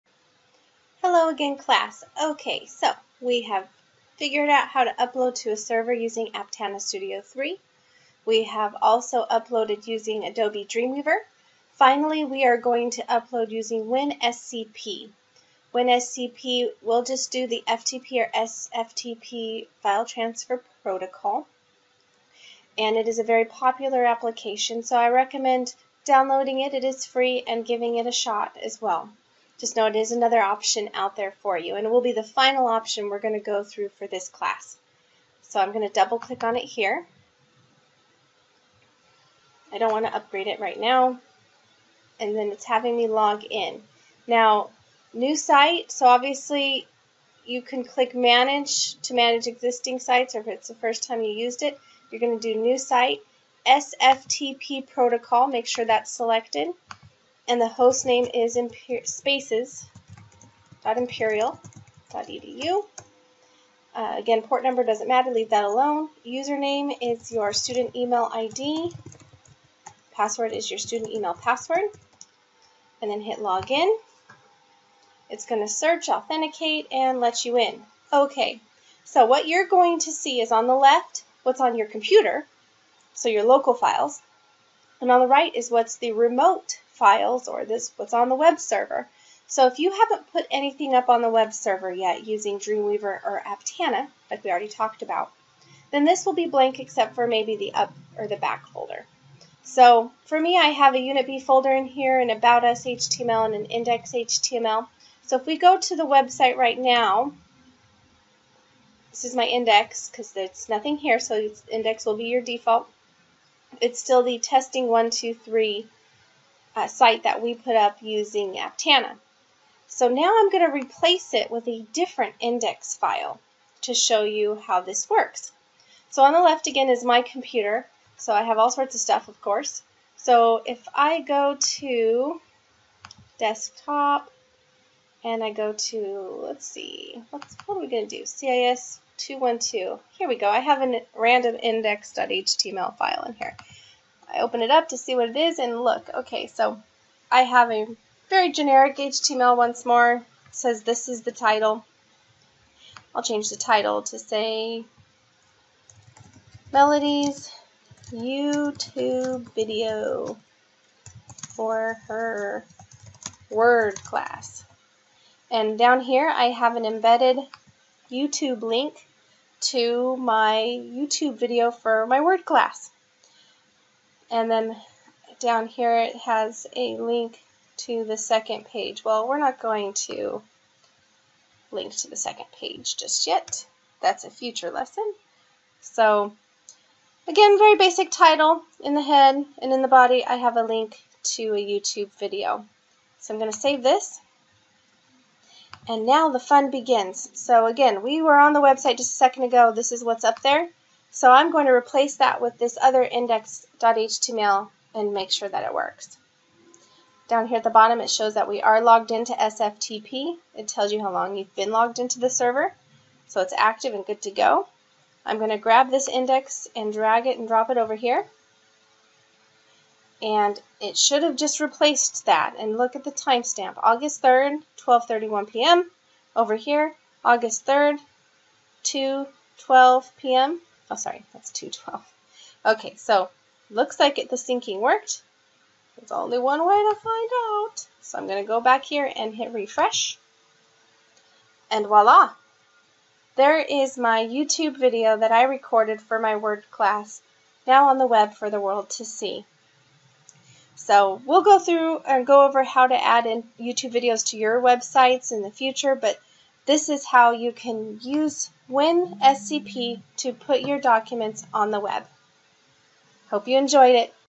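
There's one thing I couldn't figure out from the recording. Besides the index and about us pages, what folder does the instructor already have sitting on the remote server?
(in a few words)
Unit B.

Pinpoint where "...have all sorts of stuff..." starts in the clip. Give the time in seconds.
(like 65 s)
128 s.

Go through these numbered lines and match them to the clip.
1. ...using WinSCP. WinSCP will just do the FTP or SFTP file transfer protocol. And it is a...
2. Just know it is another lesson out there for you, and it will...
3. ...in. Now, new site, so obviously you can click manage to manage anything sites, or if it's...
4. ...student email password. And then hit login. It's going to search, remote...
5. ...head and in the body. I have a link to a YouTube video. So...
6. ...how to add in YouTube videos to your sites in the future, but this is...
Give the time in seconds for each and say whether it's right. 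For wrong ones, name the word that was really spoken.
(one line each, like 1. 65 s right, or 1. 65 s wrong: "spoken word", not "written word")
1. 13 s right
2. 29 s wrong: "option", not "lesson"
3. 43 s wrong: "existing", not "anything"
4. 70 s wrong: "authenticate", not "remote"
5. 189 s right
6. 252 s wrong: "websites", not "sites".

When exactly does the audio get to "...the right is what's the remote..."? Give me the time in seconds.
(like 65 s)
85 s.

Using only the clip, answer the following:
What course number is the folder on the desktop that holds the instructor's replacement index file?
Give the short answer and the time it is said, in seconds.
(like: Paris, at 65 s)
CIS 212, at 138 s.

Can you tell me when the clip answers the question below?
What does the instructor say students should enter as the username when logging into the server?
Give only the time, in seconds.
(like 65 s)
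67 s.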